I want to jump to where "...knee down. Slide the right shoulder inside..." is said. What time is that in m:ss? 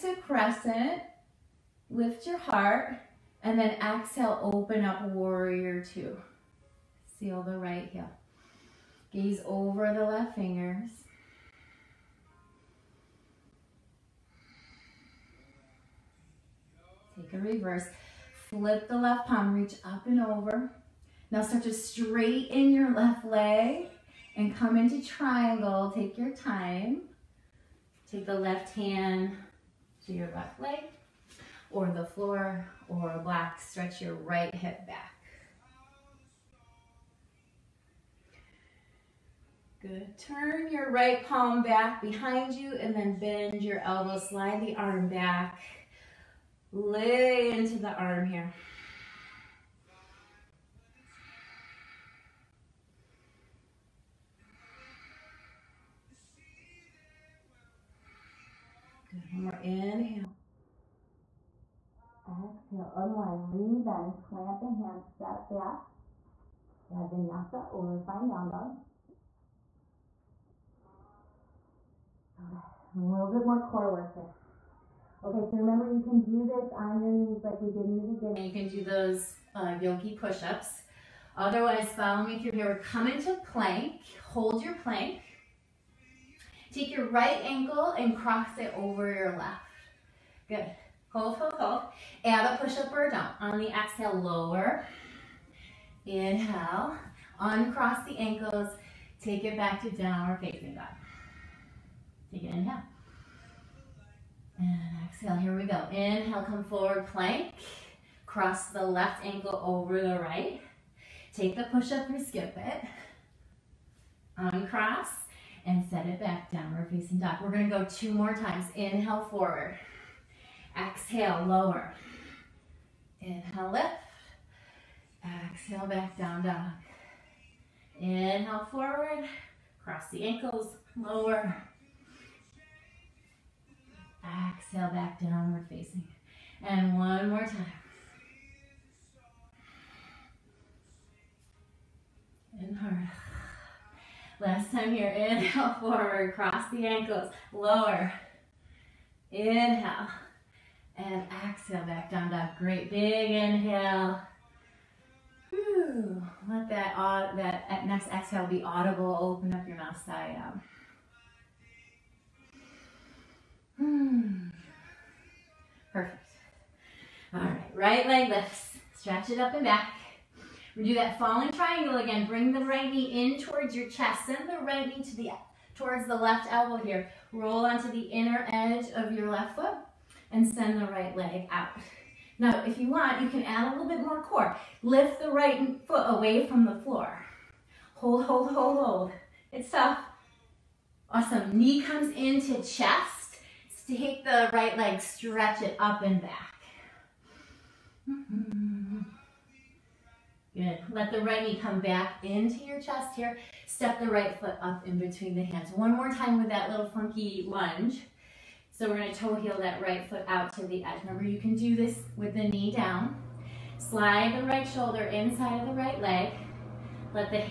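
3:32.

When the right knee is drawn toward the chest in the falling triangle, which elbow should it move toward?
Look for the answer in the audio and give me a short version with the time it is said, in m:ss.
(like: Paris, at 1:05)
Left elbow, at 2:56.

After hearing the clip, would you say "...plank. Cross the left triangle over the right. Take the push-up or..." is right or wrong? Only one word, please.
wrong.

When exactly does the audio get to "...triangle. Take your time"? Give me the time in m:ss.
0:25.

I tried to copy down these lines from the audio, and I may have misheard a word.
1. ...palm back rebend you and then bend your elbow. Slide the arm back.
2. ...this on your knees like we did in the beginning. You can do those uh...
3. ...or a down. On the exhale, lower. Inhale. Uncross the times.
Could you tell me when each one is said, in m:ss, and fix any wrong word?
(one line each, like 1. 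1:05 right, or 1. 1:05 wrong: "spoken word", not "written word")
1. 0:41 wrong: "behind", not "rebend"
2. 1:16 right
3. 1:32 wrong: "ankles", not "times".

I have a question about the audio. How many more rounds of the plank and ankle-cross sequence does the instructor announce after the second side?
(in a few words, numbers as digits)
2.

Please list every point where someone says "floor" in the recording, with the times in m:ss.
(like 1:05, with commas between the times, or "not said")
0:32, 3:06.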